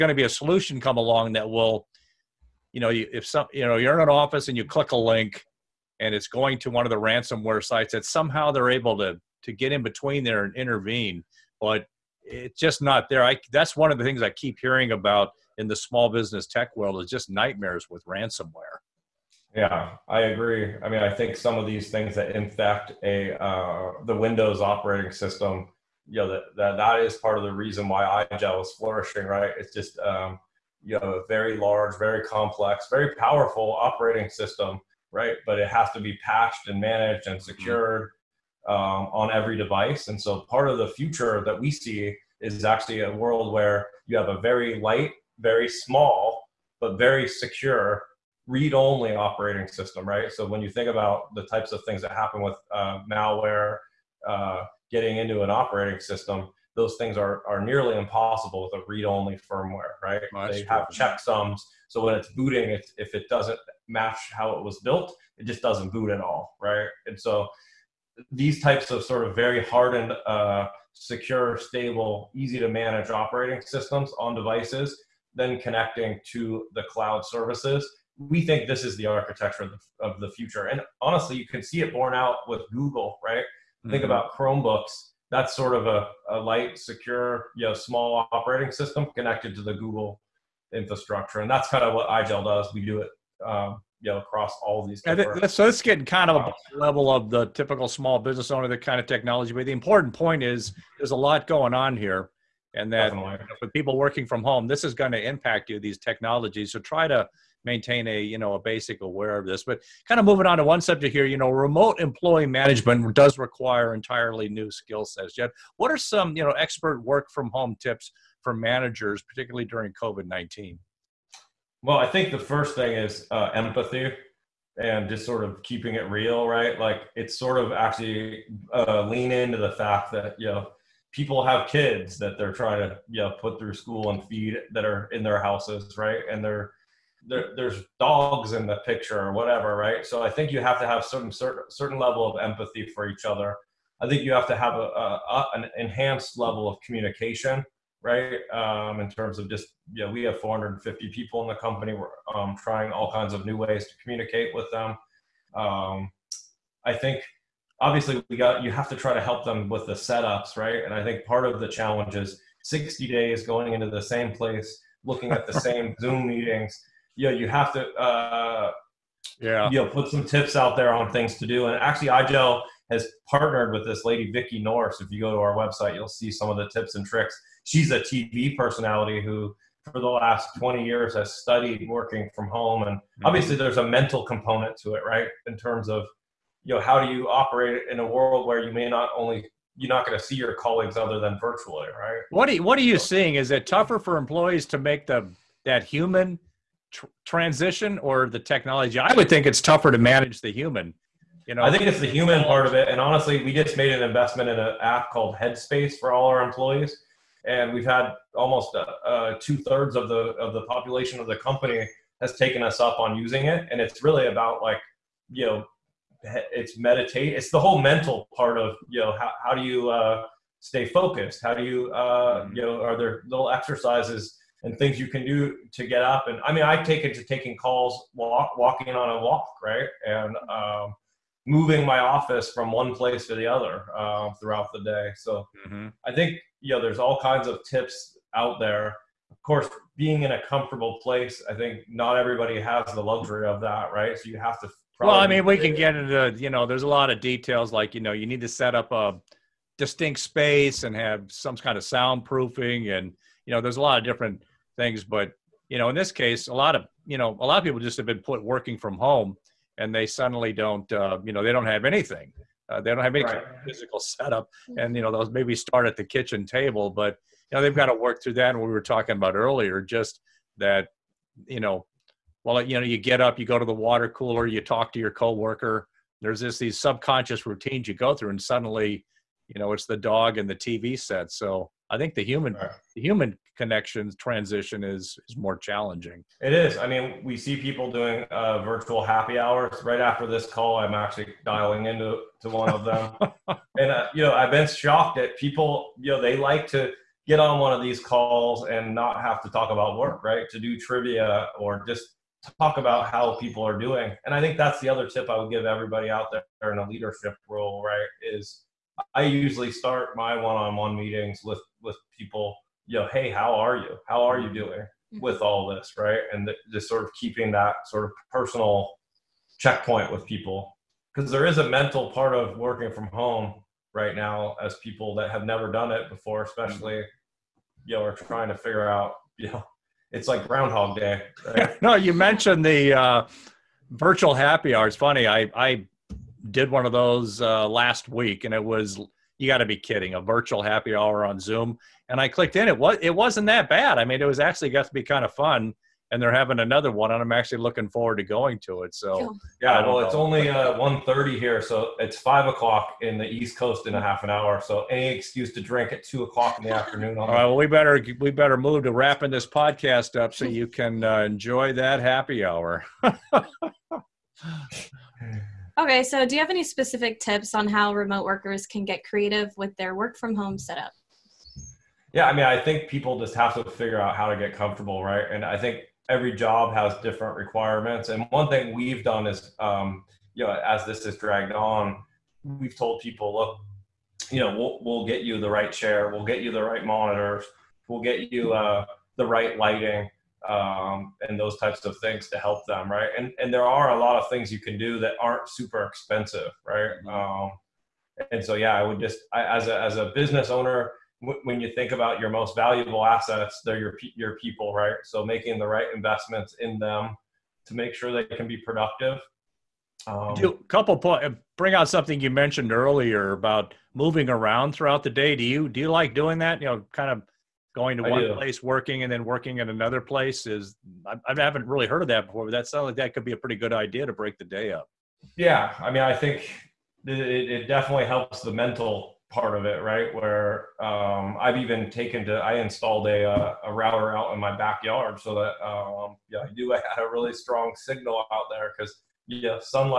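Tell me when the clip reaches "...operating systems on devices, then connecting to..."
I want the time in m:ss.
1:13.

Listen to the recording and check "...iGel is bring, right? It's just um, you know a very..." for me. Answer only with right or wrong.
wrong.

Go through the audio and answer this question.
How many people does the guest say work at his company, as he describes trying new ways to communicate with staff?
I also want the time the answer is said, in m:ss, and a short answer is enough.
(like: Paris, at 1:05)
450, at 2:30.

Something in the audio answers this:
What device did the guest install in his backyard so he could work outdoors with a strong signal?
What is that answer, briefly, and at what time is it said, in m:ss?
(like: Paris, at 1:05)
a router, at 7:13.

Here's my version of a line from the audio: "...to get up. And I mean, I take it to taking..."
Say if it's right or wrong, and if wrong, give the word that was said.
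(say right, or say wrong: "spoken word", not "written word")
right.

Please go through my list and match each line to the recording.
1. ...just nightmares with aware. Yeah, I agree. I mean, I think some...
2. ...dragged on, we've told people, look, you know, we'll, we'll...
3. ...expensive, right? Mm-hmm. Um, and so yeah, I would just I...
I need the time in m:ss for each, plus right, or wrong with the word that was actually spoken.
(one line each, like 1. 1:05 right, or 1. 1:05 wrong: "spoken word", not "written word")
1. 0:17 wrong: "ransomware", not "aware"
2. 6:21 right
3. 6:35 right.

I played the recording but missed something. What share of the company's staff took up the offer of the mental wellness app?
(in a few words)
two thirds.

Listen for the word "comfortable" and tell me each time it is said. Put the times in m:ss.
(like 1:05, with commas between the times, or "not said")
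4:00, 6:14.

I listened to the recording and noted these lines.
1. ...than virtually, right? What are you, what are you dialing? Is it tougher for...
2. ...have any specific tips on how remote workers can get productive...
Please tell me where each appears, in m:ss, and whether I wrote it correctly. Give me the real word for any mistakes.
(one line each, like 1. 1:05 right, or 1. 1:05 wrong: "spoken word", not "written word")
1. 3:11 wrong: "seeing", not "dialing"
2. 6:06 wrong: "creative", not "productive".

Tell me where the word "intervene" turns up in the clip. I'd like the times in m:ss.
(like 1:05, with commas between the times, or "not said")
0:10.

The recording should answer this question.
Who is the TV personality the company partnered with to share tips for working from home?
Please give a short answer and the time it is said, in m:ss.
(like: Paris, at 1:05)
Vicki Norris, at 2:54.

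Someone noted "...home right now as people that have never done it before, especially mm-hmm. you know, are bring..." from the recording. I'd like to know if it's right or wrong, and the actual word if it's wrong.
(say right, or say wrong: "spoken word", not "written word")
wrong: "trying", not "bring".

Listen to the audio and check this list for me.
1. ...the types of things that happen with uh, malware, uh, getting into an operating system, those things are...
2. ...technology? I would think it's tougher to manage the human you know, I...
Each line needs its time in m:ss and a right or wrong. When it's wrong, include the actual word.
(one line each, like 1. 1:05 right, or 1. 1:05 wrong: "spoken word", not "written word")
1. 0:51 right
2. 3:18 right.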